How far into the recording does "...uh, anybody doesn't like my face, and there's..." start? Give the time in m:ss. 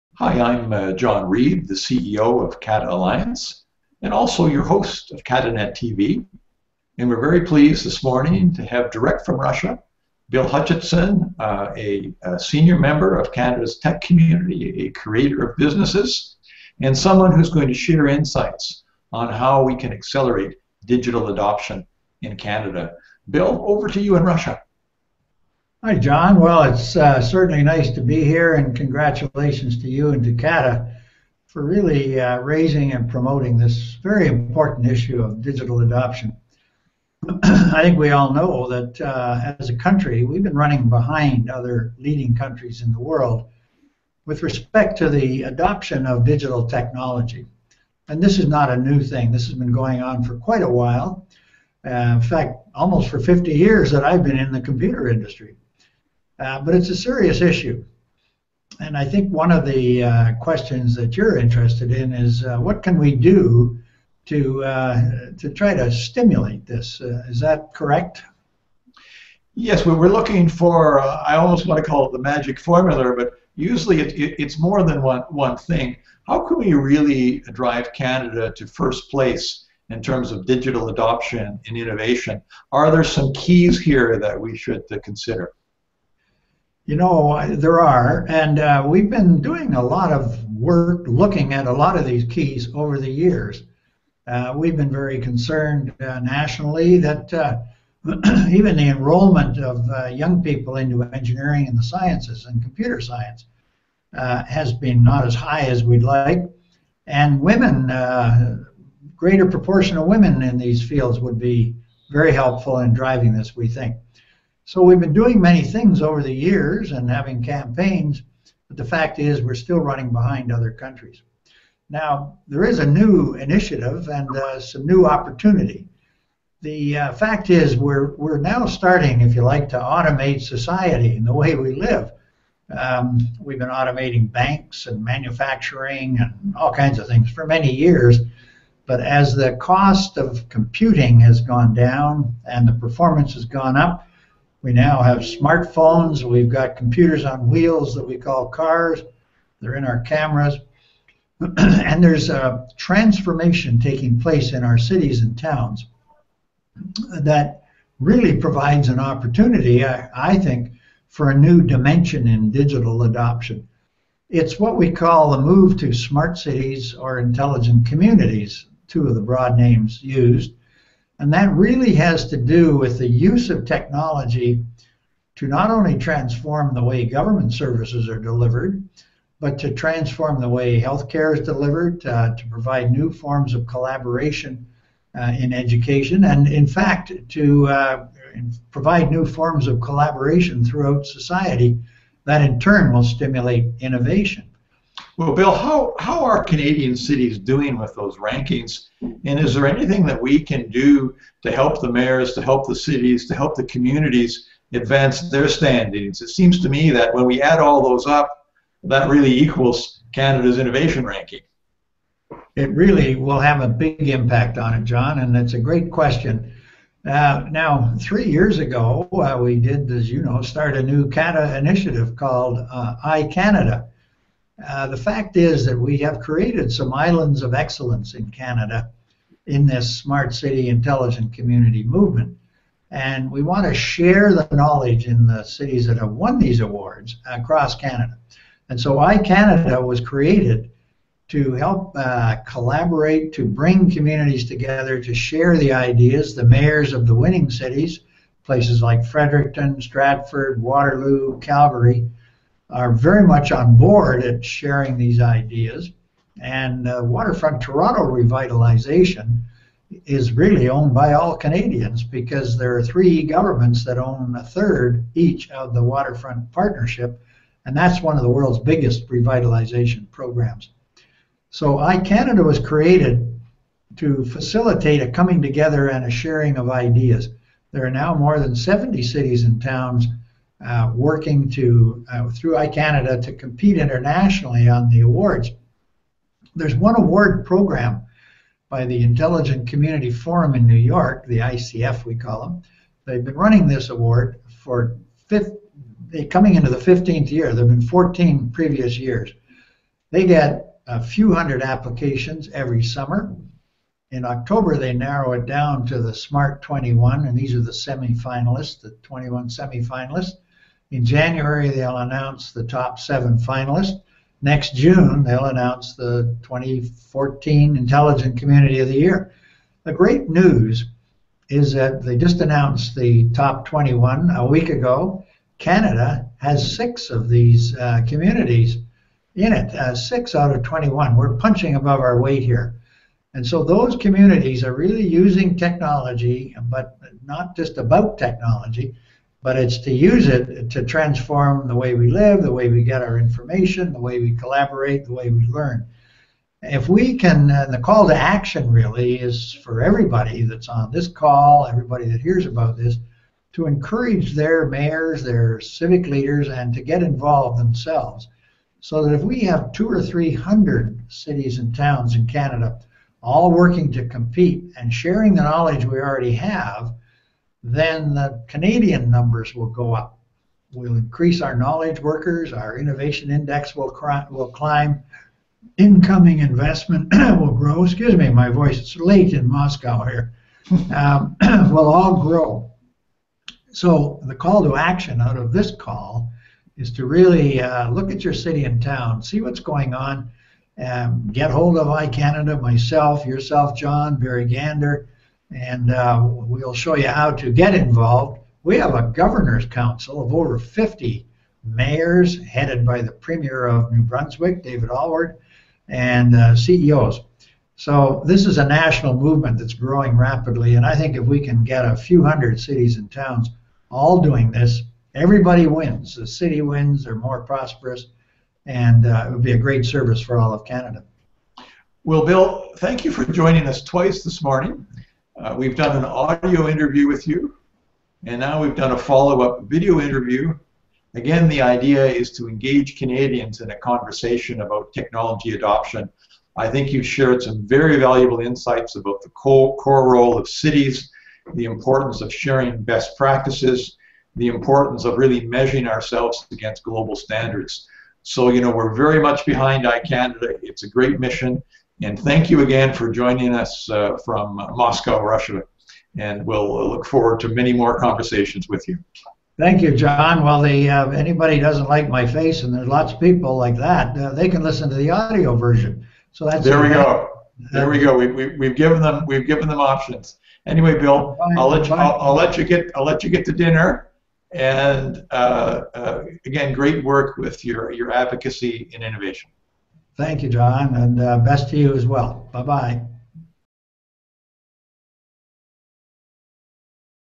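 7:40.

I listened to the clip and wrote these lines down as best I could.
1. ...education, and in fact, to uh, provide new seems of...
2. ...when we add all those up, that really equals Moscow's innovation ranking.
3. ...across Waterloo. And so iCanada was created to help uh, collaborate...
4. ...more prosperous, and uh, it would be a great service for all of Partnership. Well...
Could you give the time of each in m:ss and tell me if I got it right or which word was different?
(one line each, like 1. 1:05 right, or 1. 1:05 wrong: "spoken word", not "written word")
1. 3:05 wrong: "forms", not "seems"
2. 3:27 wrong: "Canada", not "Moscow"
3. 3:57 wrong: "Canada", not "Waterloo"
4. 6:57 wrong: "Canada", not "Partnership".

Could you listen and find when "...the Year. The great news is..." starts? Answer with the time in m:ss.
5:18.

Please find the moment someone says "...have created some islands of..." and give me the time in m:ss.
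3:45.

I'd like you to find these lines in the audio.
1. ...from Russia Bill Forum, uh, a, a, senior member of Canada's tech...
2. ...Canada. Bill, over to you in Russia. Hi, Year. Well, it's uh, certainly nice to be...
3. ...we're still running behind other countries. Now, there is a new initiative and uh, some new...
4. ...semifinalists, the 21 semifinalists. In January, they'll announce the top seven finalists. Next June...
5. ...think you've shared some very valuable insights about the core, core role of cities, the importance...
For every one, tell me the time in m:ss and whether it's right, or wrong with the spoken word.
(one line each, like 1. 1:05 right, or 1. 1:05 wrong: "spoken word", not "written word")
1. 0:09 wrong: "Hutchison", not "Forum"
2. 0:22 wrong: "John", not "Year"
3. 1:59 right
4. 5:07 right
5. 7:16 right.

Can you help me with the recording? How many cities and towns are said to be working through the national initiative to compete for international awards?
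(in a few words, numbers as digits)
more than 70.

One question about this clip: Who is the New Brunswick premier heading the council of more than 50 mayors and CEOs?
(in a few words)
David Alward.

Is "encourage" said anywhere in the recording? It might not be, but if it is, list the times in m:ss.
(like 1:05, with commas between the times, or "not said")
5:53.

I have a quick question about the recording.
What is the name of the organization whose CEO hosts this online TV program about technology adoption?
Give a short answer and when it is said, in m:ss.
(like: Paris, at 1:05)
CATA Alliance, at 0:02.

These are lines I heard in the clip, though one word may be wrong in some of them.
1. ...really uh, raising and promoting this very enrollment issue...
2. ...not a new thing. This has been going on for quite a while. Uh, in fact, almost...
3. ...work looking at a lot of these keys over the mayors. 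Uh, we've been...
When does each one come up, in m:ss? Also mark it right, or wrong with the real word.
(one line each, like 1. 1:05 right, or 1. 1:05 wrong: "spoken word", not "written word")
1. 0:31 wrong: "important", not "enrollment"
2. 0:48 right
3. 1:30 wrong: "years", not "mayors".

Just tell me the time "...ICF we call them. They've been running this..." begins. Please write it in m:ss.
4:51.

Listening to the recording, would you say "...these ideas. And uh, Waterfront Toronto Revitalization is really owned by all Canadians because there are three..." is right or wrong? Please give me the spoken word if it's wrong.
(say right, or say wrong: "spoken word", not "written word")
right.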